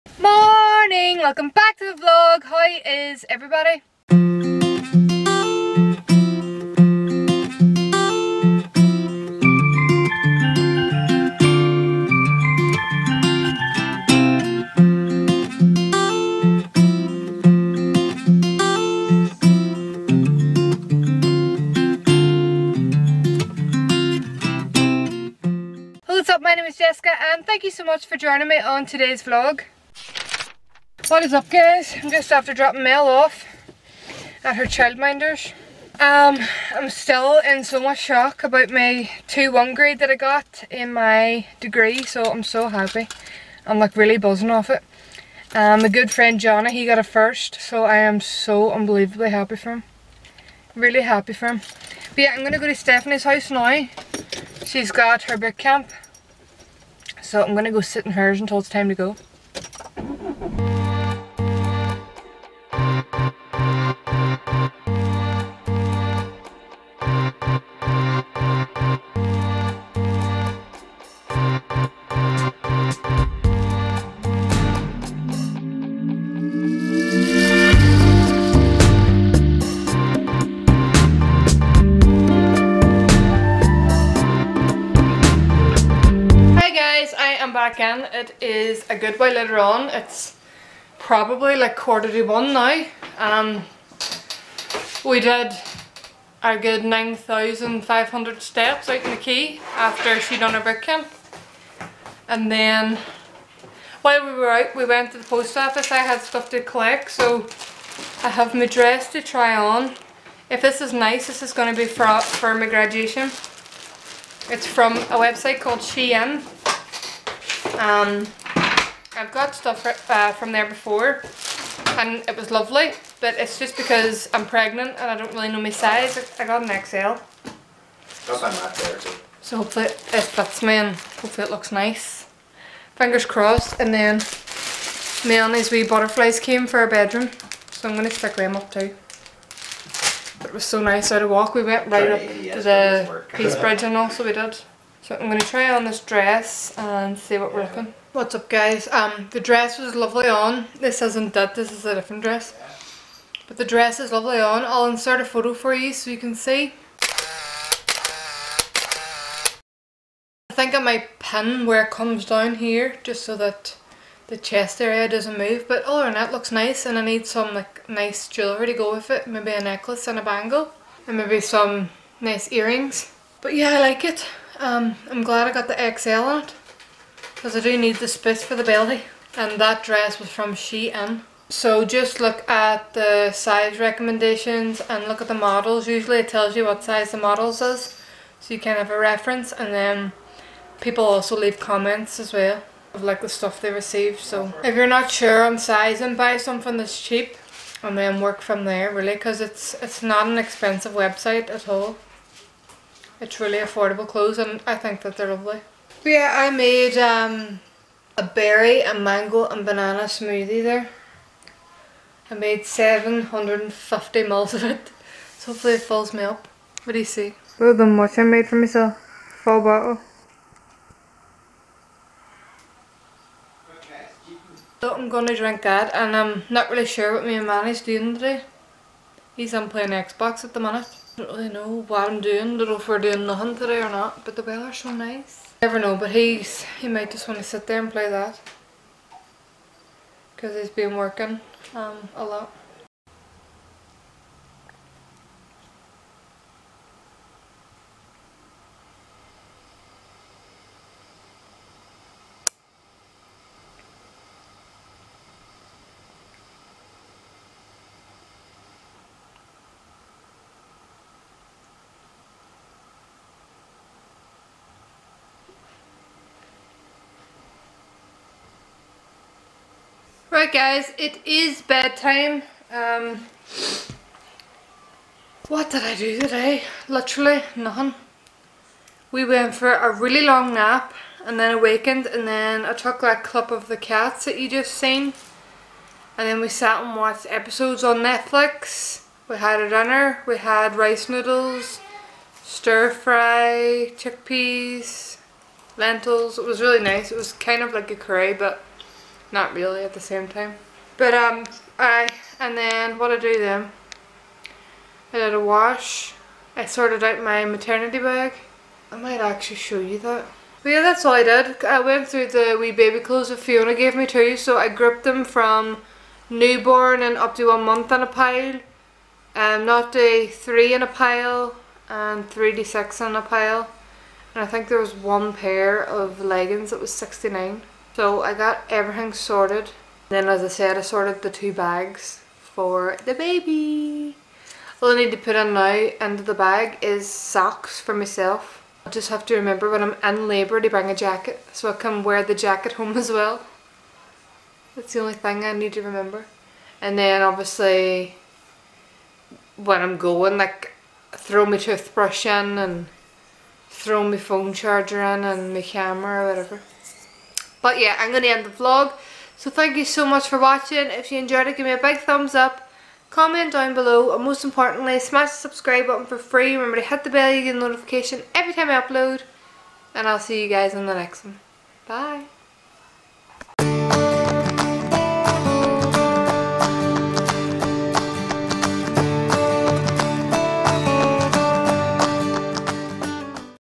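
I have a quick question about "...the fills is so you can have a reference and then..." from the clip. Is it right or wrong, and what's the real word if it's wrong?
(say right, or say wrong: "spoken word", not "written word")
wrong: "models", not "fills".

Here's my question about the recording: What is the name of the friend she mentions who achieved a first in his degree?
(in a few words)
Johnny.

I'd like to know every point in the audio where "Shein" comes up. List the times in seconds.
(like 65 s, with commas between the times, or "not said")
115 s, 180 s.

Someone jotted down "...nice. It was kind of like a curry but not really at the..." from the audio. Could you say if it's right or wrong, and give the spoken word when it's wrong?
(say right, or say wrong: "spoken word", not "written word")
right.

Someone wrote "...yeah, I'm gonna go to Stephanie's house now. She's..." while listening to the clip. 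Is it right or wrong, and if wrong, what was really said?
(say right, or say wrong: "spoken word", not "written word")
right.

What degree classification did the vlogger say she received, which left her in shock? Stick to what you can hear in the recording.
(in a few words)
2-1.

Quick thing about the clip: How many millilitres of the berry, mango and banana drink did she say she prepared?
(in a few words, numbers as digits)
750.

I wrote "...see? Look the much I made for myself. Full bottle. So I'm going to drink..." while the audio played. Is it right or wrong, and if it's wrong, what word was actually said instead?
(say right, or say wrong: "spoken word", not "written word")
right.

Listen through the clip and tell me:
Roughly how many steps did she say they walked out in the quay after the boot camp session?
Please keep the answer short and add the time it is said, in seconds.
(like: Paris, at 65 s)
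9,500, at 96 s.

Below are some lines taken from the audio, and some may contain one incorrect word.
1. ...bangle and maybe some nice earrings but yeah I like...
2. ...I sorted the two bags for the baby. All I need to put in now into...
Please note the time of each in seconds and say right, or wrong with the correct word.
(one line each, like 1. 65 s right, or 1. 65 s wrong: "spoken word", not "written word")
1. 170 s right
2. 330 s right.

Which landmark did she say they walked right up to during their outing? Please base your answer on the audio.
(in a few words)
Peace Bridge.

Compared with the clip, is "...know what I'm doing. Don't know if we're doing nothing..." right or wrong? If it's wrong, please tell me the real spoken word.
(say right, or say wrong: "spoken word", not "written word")
right.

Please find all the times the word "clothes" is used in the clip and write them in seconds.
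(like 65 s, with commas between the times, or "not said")
204 s, 312 s.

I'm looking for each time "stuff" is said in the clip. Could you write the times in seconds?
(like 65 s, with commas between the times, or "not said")
106 s, 119 s, 193 s.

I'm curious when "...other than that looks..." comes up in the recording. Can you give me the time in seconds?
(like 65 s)
165 s.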